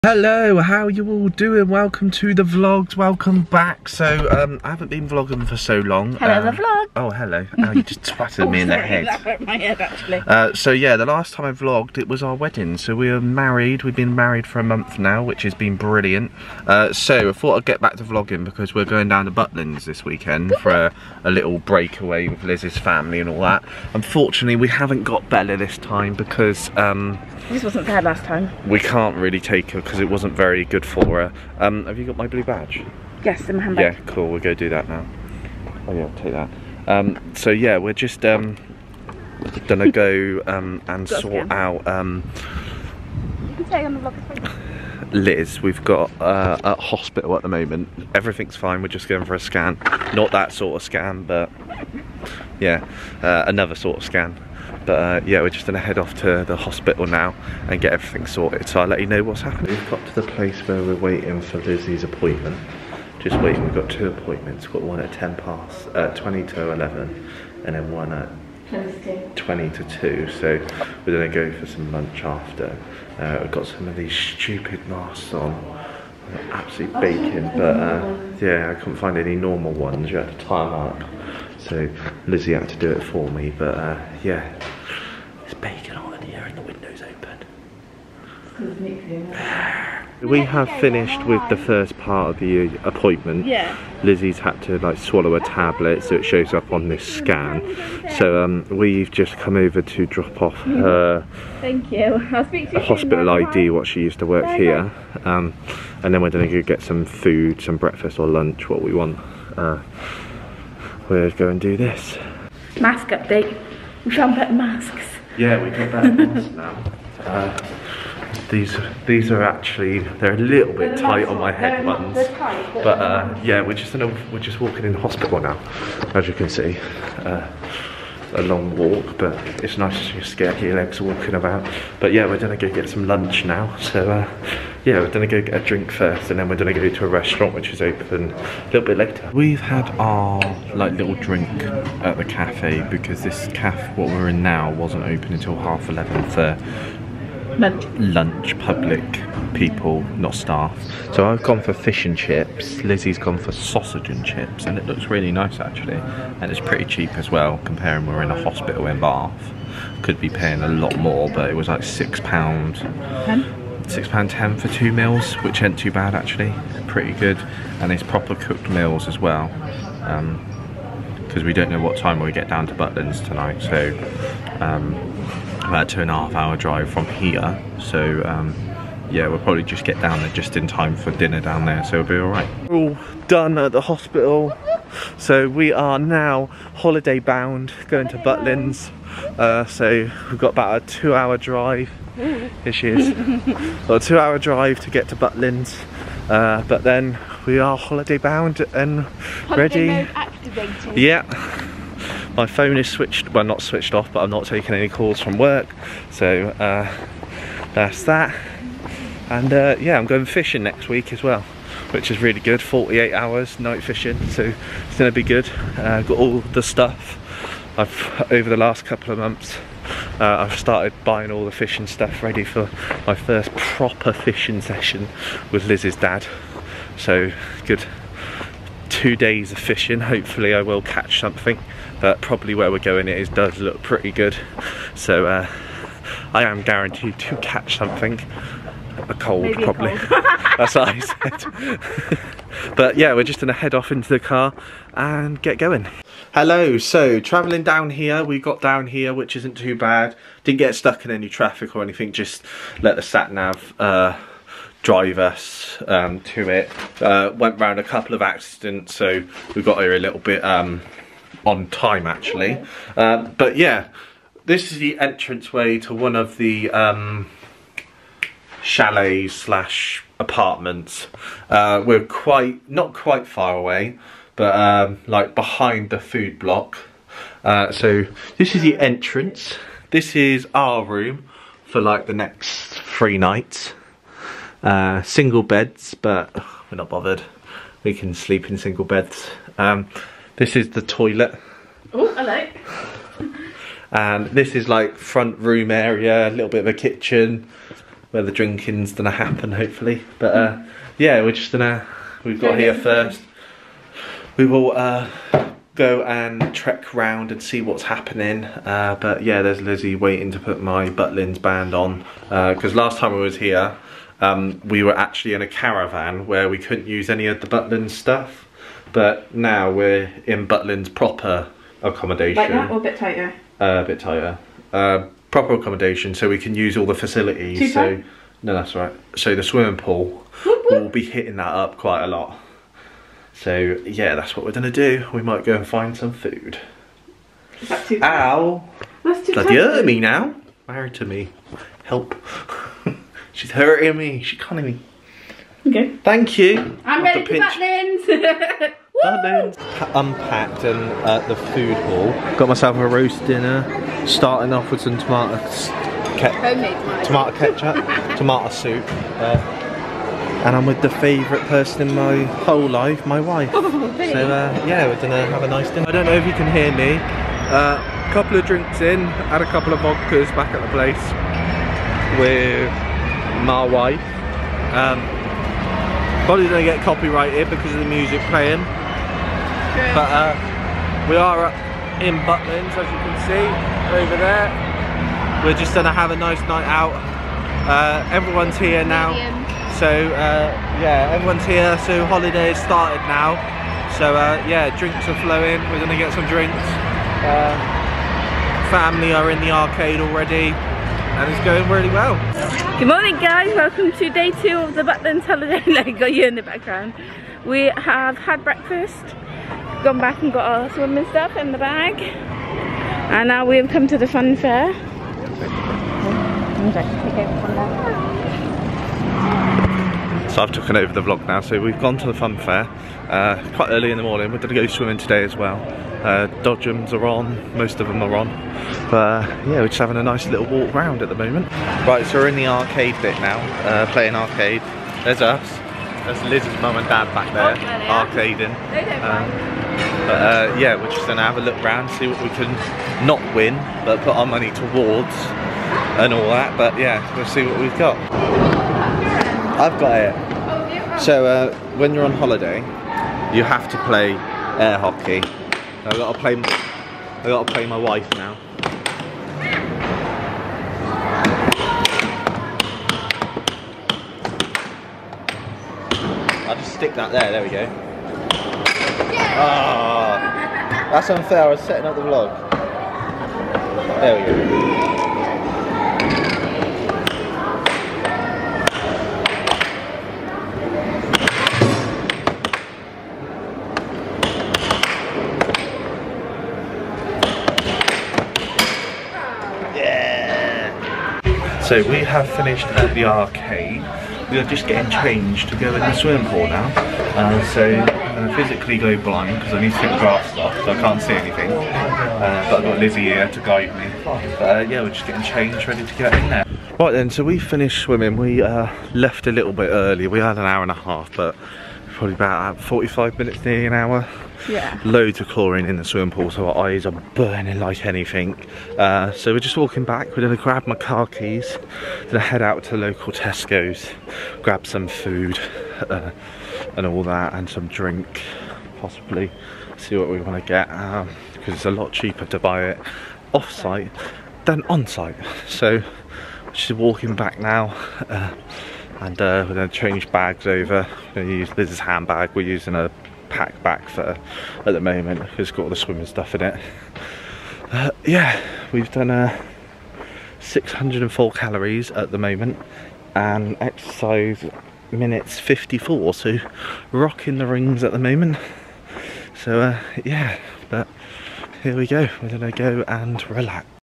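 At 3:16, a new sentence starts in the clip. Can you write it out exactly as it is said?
Uh, but then we are holiday bound and holiday ready.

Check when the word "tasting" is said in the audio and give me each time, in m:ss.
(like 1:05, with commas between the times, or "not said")
not said.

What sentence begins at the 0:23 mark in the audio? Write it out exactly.
Unfortunately, we haven't got Bella this time because...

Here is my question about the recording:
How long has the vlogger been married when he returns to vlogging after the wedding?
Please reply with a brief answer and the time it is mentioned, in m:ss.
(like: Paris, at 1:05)
a month, at 0:14.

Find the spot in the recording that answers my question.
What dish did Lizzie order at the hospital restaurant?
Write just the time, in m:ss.
2:33.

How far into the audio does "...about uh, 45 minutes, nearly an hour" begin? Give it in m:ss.
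8:32.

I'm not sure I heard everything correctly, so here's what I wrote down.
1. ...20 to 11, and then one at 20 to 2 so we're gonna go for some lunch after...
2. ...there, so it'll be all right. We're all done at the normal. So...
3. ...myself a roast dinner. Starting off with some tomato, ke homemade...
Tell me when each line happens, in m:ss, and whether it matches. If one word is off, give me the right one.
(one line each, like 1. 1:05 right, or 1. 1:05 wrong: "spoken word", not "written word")
1. 1:06 right
2. 3:01 wrong: "hospital", not "normal"
3. 5:52 right.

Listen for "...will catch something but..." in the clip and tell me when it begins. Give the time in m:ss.
3:50.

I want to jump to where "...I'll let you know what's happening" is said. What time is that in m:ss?
0:58.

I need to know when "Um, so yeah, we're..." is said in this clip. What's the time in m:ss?
0:36.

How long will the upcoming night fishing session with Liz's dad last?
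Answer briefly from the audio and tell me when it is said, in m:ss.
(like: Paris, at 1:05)
48 hours, at 3:32.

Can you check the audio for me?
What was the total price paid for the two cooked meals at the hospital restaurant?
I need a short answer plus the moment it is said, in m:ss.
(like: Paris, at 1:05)
£6.10, at 2:43.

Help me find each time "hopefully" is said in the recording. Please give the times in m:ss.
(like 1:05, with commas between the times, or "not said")
3:50, 4:59.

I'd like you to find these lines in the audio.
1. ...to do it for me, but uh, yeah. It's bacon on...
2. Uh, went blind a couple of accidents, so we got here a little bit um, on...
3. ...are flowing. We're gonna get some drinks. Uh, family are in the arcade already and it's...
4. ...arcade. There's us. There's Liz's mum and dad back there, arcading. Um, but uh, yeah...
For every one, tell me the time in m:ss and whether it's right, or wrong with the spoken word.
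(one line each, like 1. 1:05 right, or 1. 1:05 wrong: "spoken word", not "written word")
1. 1:22 right
2. 4:17 wrong: "round", not "blind"
3. 6:35 right
4. 7:14 right.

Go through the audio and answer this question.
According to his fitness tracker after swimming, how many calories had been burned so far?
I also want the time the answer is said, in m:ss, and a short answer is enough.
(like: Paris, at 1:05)
604, at 9:10.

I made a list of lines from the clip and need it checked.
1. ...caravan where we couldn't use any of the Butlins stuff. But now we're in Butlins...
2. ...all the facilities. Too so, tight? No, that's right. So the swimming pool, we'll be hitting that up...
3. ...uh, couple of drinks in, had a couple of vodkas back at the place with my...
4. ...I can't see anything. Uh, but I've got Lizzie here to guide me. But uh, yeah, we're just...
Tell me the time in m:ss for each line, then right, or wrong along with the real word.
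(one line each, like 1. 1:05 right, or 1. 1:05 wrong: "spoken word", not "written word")
1. 5:15 right
2. 5:26 right
3. 6:07 right
4. 8:20 right.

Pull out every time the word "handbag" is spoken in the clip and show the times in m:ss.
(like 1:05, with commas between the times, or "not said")
0:33, 9:01.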